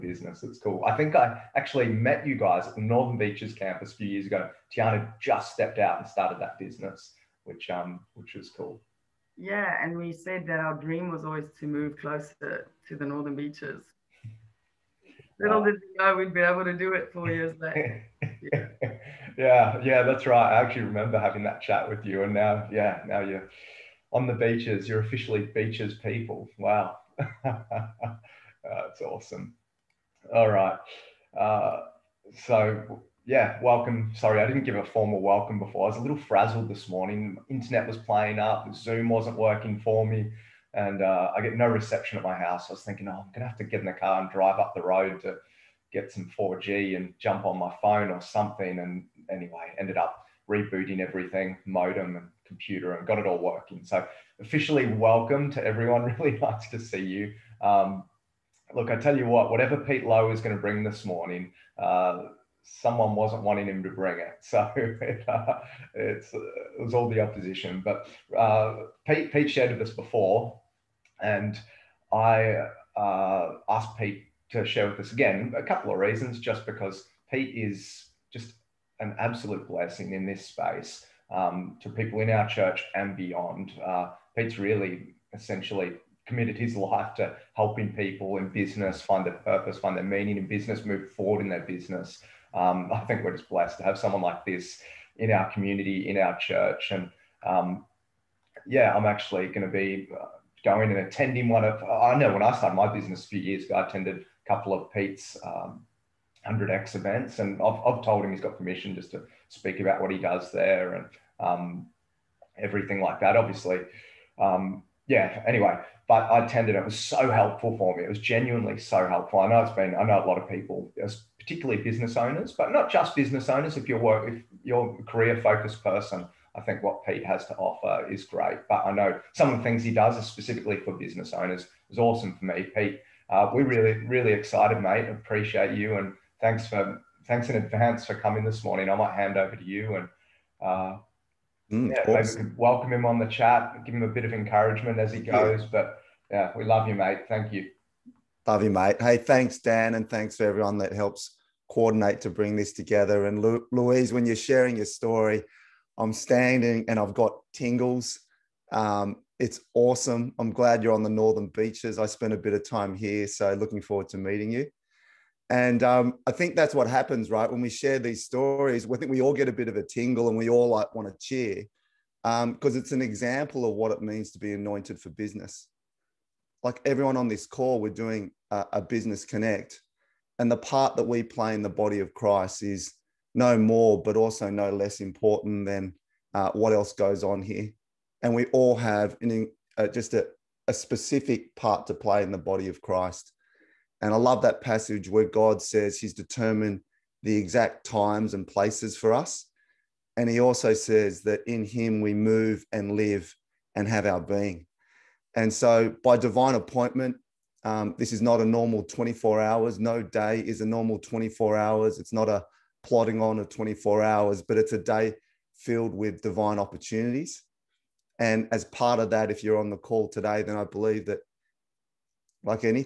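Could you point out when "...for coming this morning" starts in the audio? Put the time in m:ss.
2:18.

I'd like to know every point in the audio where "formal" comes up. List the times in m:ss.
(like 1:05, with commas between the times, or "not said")
0:34.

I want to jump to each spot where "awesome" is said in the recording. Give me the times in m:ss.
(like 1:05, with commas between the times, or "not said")
0:29, 2:11, 2:39.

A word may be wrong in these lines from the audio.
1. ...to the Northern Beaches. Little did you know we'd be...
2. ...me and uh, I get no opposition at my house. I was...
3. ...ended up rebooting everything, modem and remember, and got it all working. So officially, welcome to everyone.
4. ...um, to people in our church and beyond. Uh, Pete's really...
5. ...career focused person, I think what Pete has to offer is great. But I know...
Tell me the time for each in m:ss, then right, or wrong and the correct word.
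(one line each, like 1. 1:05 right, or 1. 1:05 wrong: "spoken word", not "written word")
1. 0:12 right
2. 0:40 wrong: "reception", not "opposition"
3. 0:49 wrong: "computer", not "remember"
4. 1:21 right
5. 2:05 right.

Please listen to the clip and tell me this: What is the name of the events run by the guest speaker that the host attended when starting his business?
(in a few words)
100X.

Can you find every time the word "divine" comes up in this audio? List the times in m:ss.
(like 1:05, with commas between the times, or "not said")
3:26, 3:36.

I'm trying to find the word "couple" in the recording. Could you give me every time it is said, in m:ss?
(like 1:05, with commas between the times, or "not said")
1:15, 1:44.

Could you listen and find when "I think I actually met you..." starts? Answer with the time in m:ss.
0:00.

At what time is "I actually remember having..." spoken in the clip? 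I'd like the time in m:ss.
0:20.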